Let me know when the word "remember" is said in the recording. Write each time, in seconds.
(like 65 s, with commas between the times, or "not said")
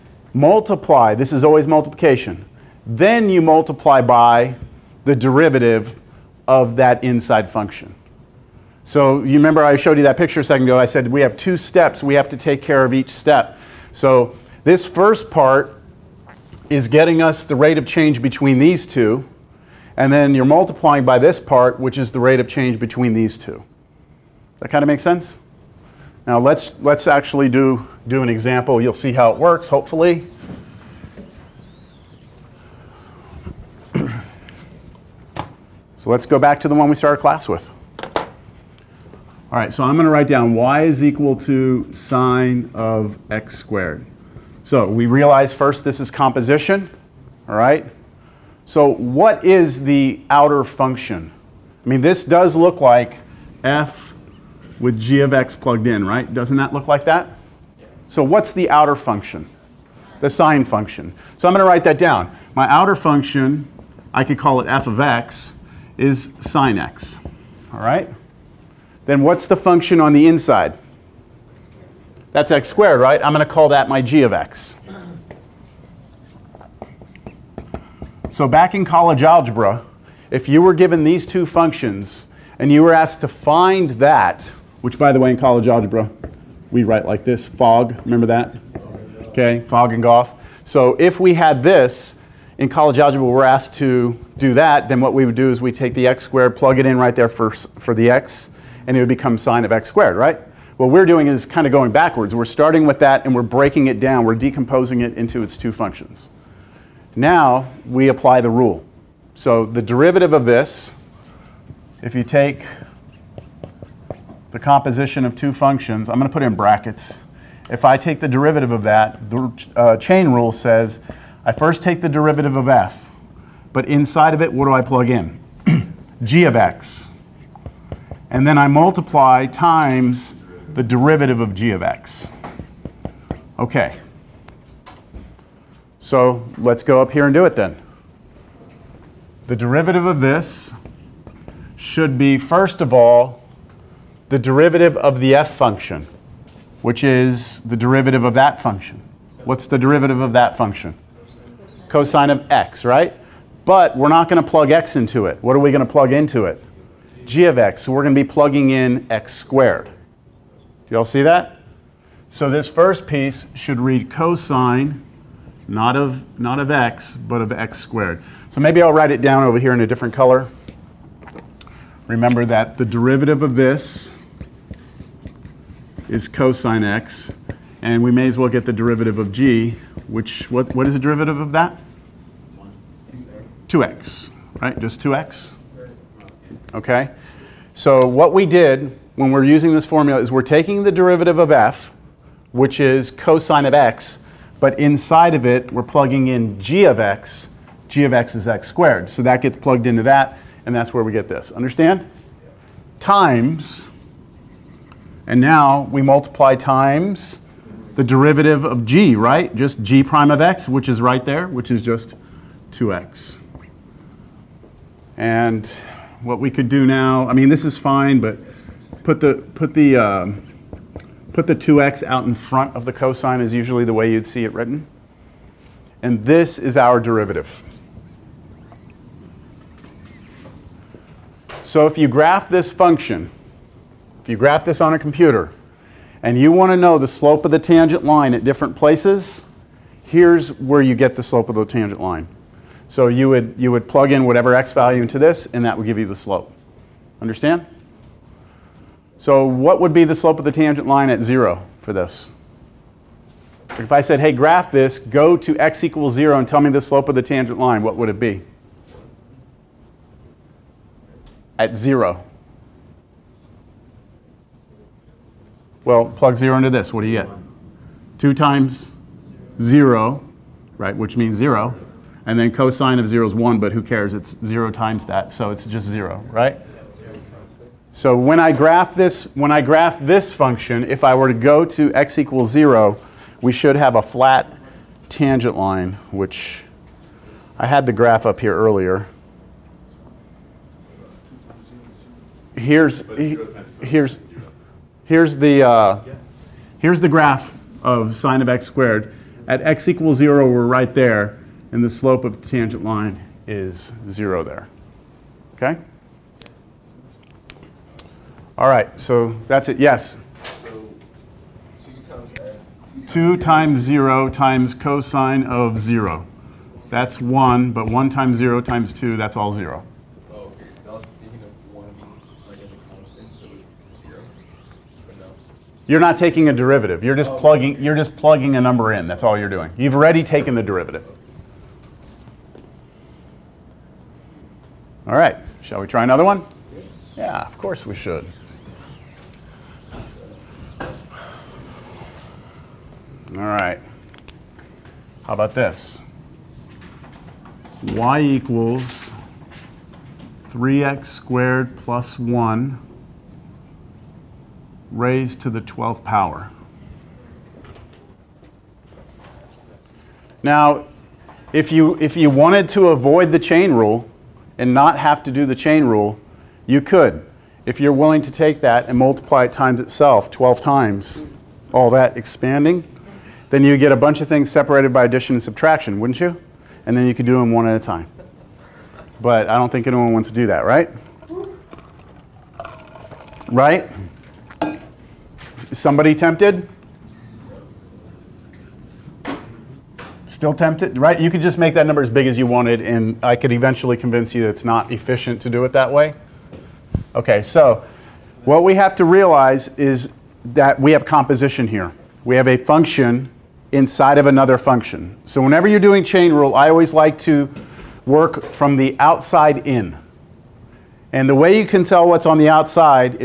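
9 s, 88 s, 172 s.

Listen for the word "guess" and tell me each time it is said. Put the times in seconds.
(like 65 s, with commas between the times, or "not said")
not said.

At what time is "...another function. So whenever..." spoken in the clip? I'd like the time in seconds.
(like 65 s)
404 s.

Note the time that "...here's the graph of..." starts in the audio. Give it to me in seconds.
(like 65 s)
296 s.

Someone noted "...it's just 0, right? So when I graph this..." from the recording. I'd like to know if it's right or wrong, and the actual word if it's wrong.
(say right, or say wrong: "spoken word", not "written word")
right.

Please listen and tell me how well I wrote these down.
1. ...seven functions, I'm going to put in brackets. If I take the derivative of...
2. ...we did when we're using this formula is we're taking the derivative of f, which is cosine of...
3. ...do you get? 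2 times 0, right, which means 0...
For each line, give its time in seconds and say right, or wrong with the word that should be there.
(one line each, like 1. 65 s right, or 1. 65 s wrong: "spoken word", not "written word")
1. 115 s wrong: "two", not "seven"
2. 188 s right
3. 267 s right.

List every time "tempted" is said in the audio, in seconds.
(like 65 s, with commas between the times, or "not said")
386 s, 390 s.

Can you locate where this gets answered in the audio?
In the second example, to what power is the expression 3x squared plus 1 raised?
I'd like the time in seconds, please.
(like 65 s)
355 s.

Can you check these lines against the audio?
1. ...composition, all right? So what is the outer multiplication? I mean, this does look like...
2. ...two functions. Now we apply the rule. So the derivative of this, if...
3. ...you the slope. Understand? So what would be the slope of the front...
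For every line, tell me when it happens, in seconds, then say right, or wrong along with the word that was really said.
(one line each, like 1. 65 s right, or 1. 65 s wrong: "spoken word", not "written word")
1. 46 s wrong: "function", not "multiplication"
2. 105 s right
3. 245 s wrong: "tangent", not "front".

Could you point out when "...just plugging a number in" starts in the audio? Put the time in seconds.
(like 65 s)
327 s.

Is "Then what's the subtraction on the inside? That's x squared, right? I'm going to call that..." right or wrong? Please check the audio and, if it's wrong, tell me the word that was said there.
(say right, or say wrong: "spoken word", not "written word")
wrong: "function", not "subtraction".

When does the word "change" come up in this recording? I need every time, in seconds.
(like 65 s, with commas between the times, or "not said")
17 s, 22 s.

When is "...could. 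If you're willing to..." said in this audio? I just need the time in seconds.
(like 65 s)
366 s.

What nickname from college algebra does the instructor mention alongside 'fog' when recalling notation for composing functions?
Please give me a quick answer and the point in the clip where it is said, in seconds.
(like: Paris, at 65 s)
golf, at 90 s.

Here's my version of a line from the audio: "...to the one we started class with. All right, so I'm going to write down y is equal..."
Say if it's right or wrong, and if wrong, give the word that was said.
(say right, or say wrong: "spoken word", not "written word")
right.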